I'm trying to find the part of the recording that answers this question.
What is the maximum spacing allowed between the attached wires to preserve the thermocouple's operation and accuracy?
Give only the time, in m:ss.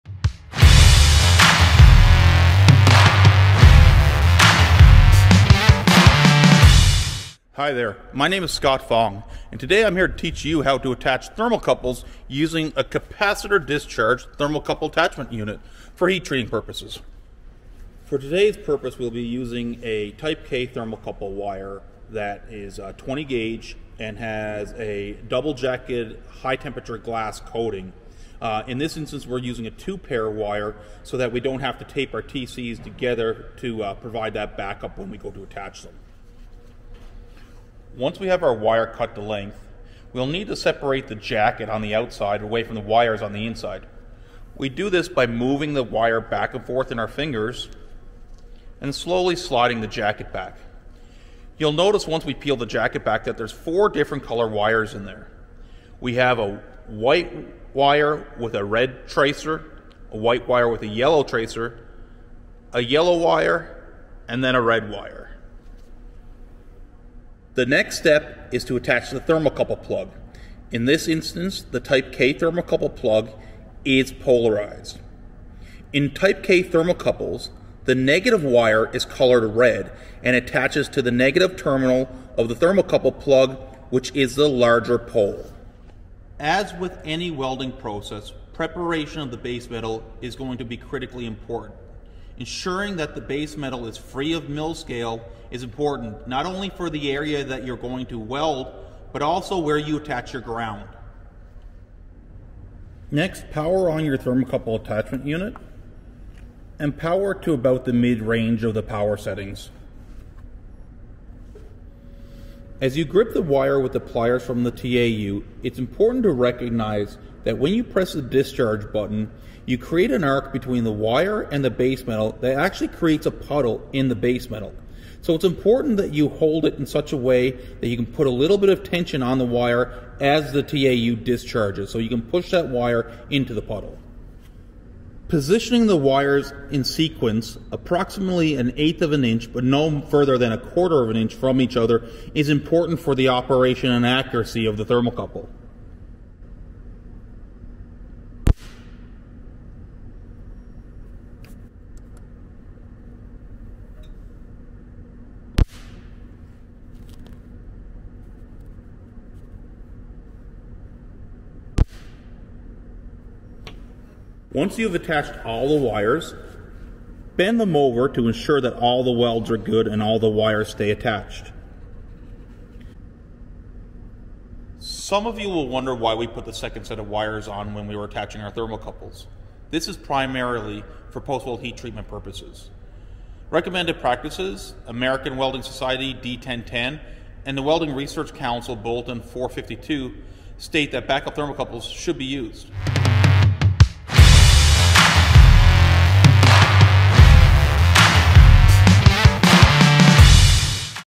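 2:20.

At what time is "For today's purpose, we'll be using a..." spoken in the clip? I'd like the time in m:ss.
0:18.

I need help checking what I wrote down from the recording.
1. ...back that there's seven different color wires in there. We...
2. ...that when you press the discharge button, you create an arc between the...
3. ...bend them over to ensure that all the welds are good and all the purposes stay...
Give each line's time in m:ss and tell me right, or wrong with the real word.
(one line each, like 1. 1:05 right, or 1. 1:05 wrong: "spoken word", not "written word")
1. 0:53 wrong: "four", not "seven"
2. 1:57 right
3. 2:47 wrong: "wires", not "purposes".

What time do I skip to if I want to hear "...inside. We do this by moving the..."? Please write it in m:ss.
0:43.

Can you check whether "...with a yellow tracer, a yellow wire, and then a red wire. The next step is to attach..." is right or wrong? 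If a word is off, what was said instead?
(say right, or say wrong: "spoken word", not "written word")
right.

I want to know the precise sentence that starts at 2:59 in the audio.
This is primarily for post-weld heat treatment purposes.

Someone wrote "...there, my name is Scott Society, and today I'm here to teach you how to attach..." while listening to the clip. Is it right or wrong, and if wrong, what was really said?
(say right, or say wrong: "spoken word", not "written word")
wrong: "Fong", not "Society".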